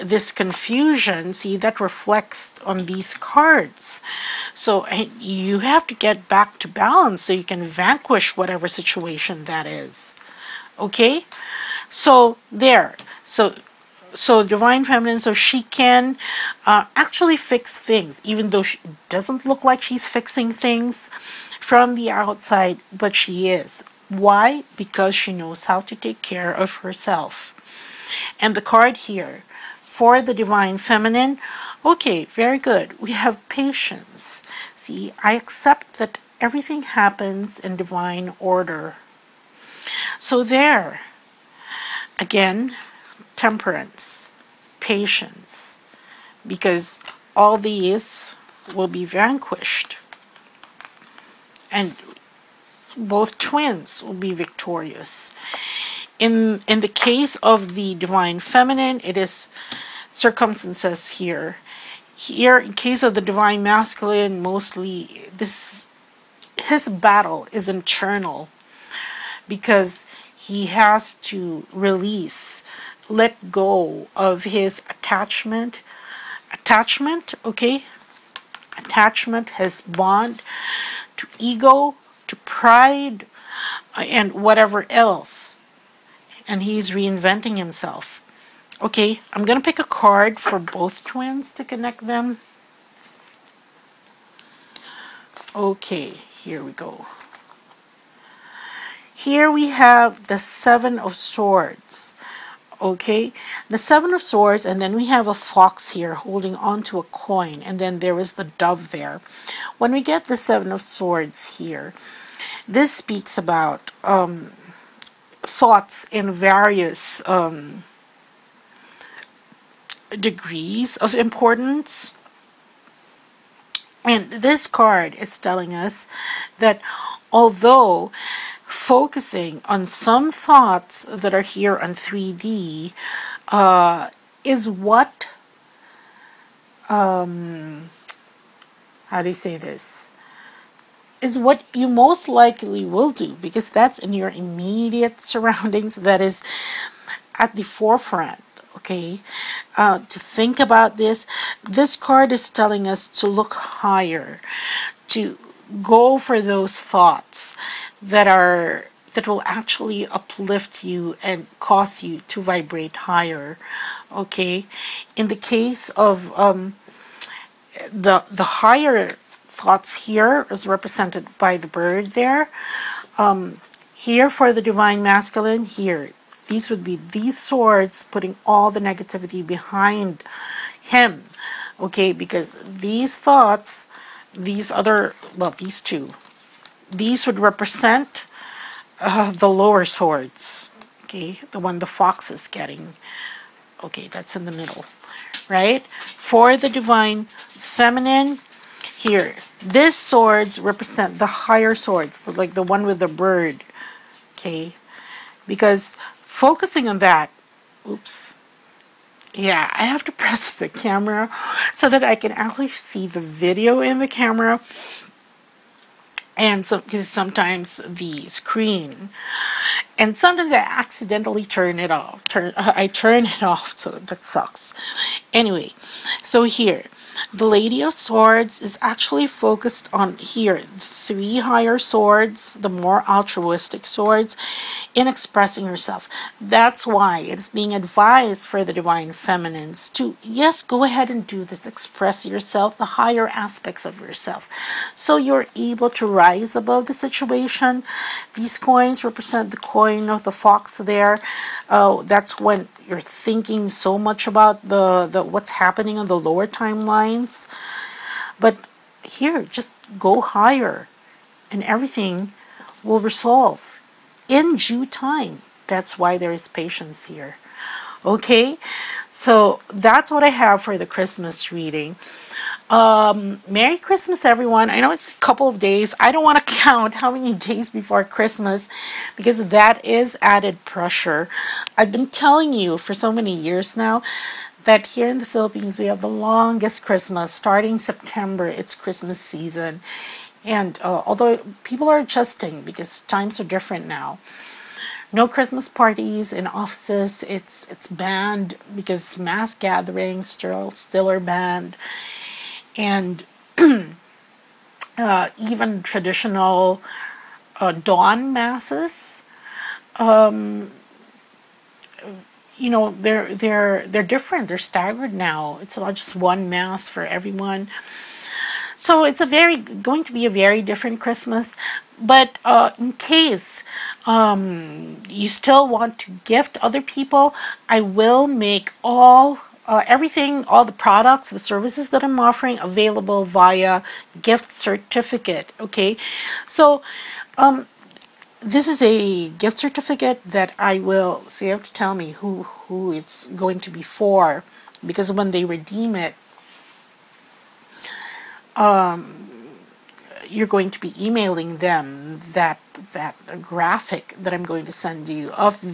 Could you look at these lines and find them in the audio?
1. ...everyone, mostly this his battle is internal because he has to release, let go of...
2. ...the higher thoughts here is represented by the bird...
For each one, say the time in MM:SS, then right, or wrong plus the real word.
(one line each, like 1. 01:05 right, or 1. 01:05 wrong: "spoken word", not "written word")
1. 01:03 wrong: "masculine", not "everyone"
2. 02:48 right.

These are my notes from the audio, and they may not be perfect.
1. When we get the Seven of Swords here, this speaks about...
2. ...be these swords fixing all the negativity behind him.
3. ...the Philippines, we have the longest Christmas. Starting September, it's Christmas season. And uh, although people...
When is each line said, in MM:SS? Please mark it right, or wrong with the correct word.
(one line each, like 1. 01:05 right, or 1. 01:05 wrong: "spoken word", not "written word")
1. 01:49 right
2. 02:56 wrong: "putting", not "fixing"
3. 04:45 right.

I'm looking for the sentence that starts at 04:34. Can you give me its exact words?
I know it's a couple of days.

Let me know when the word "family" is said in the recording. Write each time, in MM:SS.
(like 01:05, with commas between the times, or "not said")
not said.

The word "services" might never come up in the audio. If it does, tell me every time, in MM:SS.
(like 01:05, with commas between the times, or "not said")
05:31.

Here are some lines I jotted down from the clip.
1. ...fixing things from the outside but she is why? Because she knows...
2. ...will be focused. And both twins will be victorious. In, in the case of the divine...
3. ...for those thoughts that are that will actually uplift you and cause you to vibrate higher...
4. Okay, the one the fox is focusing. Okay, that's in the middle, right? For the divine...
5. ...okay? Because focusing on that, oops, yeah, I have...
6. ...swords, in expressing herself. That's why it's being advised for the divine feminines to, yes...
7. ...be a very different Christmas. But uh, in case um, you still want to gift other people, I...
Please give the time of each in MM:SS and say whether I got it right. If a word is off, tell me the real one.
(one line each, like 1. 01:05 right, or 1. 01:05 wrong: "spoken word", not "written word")
1. 00:20 right
2. 00:48 wrong: "vanquished", not "focused"
3. 02:36 right
4. 03:11 wrong: "getting", not "focusing"
5. 03:24 right
6. 03:53 right
7. 05:20 right.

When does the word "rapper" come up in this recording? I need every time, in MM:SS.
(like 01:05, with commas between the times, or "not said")
not said.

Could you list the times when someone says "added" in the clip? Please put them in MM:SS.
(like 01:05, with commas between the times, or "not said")
04:40.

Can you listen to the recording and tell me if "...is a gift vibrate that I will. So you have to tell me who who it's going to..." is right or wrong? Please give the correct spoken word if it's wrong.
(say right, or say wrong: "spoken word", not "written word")
wrong: "certificate", not "vibrate".